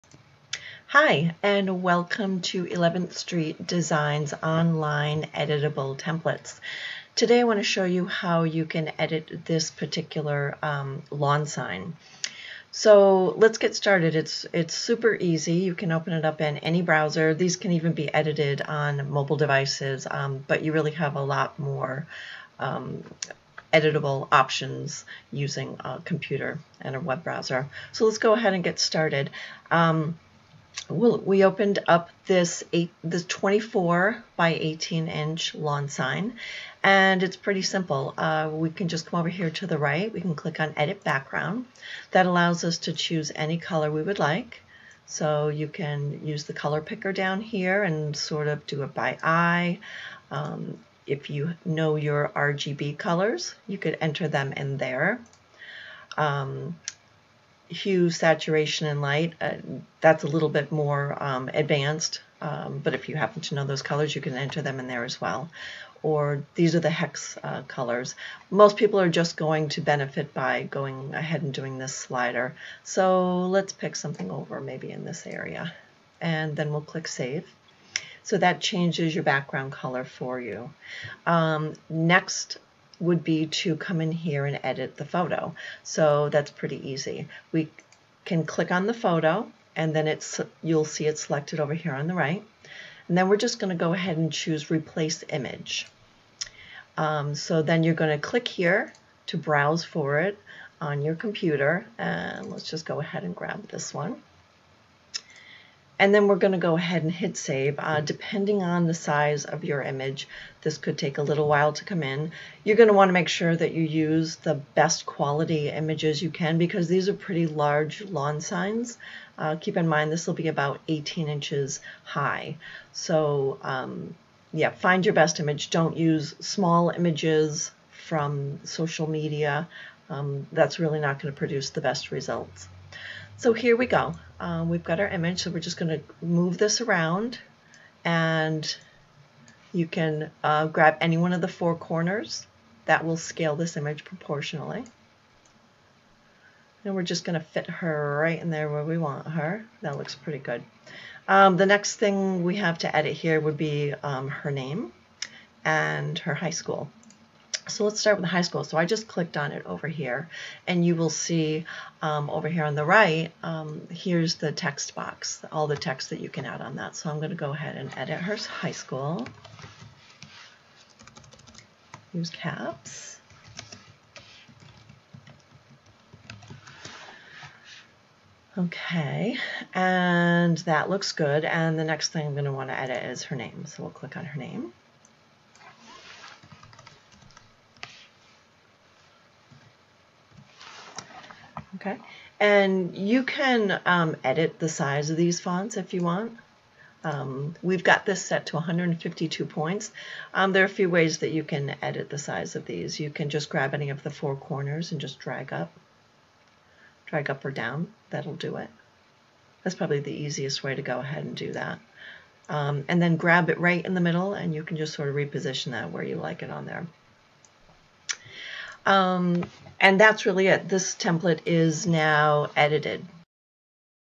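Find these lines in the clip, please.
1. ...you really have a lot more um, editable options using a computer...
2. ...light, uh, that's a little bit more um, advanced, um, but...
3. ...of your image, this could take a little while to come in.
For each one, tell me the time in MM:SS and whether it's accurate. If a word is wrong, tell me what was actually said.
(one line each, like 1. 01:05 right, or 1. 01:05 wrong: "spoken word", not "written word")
1. 00:20 right
2. 00:59 right
3. 01:49 right.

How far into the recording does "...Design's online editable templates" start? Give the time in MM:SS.
00:03.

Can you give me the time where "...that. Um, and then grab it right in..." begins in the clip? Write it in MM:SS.
03:31.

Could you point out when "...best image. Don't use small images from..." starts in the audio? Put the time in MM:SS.
02:05.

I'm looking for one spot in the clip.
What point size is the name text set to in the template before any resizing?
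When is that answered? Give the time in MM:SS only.
03:18.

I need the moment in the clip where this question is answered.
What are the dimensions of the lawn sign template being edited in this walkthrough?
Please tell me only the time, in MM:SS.
00:33.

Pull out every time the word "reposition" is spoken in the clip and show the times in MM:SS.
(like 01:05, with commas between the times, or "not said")
03:35.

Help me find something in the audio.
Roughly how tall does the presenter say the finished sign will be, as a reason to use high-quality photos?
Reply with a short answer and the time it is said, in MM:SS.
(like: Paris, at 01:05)
18 inches, at 02:00.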